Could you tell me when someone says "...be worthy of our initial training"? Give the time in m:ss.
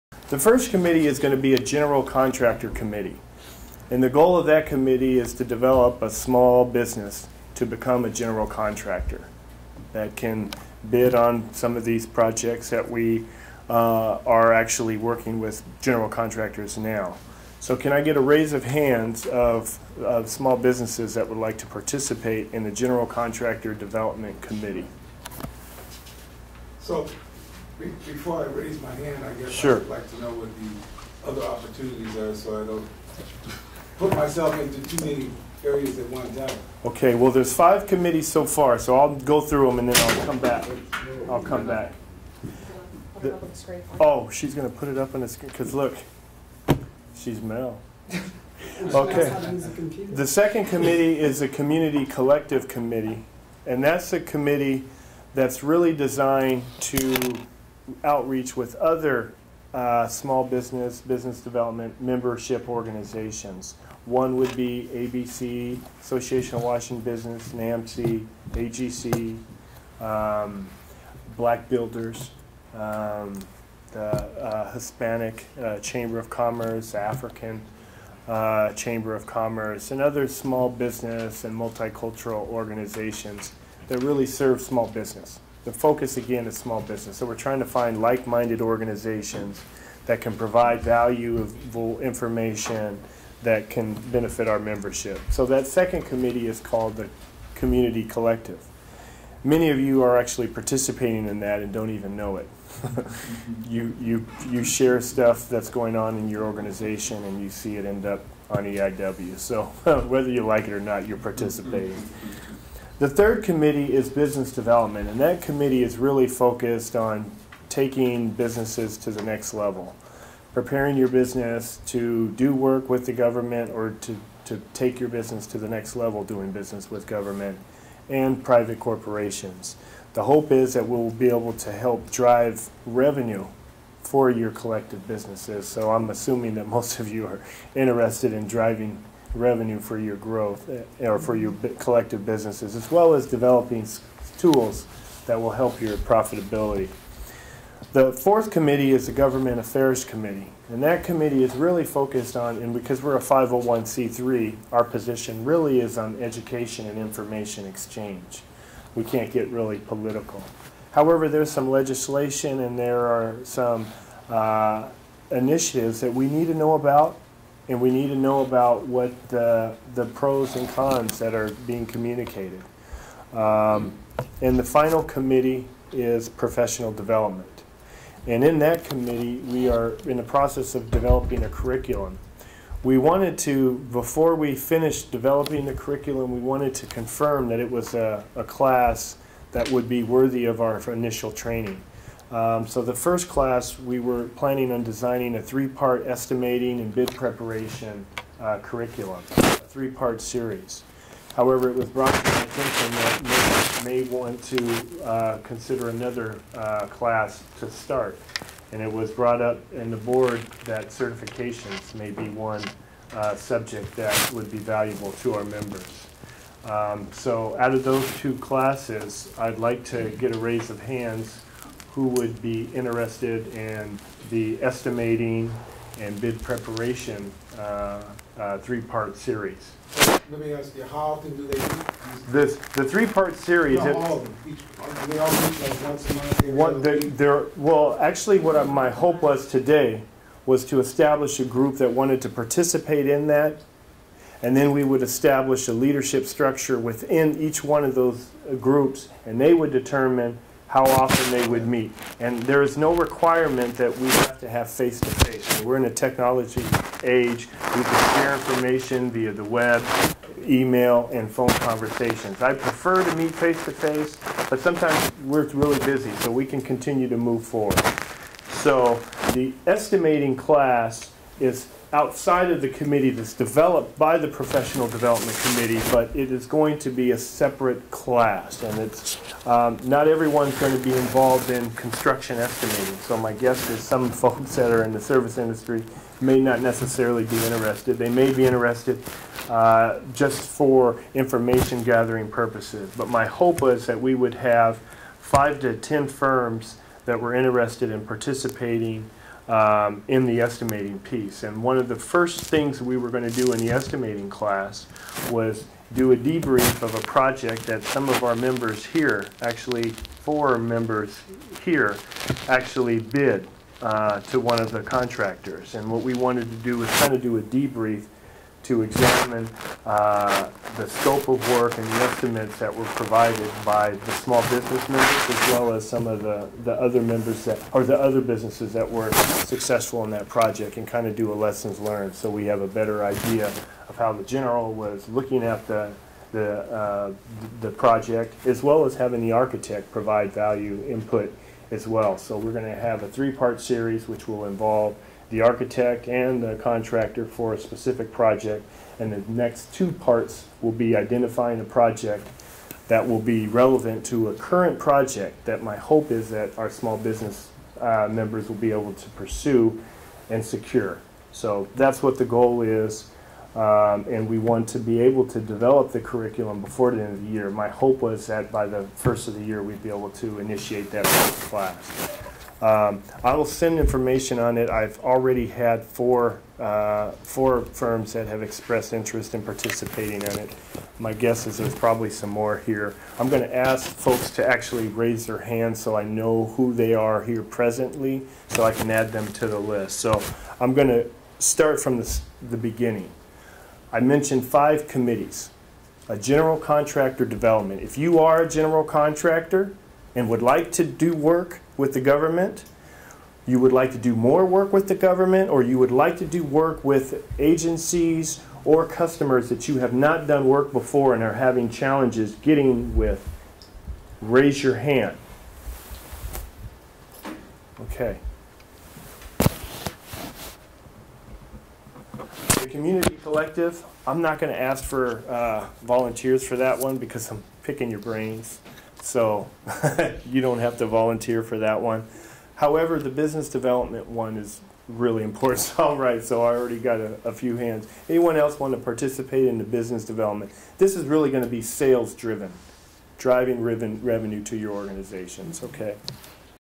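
3:09.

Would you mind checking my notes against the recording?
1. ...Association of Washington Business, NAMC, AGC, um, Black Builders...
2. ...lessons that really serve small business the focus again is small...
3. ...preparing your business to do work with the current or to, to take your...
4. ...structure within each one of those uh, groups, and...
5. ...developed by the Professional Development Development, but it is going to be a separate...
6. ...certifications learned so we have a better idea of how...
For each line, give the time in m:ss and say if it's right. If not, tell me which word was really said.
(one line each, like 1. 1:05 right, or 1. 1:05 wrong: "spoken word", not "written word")
1. 1:06 right
2. 1:22 wrong: "organizations", not "lessons"
3. 2:00 wrong: "government", not "current"
4. 4:06 right
5. 4:33 wrong: "Committee", not "Development"
6. 5:31 wrong: "lessons", not "certifications".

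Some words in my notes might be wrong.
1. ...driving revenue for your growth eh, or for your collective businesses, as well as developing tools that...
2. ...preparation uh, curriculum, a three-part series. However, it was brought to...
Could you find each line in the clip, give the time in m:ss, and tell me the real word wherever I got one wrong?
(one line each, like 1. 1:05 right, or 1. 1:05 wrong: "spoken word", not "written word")
1. 2:18 right
2. 3:17 right.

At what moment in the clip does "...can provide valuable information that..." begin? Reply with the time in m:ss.
1:30.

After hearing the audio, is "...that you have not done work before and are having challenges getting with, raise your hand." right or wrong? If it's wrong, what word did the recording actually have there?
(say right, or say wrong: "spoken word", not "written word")
right.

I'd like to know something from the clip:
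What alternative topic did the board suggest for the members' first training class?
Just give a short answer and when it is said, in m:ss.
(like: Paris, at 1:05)
Certifications, at 3:30.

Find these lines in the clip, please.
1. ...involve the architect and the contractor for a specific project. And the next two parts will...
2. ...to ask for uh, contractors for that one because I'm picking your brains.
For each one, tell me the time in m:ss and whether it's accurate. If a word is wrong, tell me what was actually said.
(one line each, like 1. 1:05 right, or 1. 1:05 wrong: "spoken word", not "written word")
1. 5:44 right
2. 7:04 wrong: "volunteers", not "contractors".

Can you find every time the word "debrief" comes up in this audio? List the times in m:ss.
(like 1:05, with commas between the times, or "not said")
5:06, 5:17.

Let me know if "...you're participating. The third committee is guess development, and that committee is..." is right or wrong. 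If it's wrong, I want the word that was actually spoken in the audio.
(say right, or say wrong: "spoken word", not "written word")
wrong: "business", not "guess".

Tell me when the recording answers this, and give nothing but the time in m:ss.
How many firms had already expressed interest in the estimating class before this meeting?
6:17.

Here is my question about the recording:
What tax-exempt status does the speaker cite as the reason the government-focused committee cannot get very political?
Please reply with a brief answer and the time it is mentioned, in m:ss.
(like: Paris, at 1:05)
501c3, at 2:33.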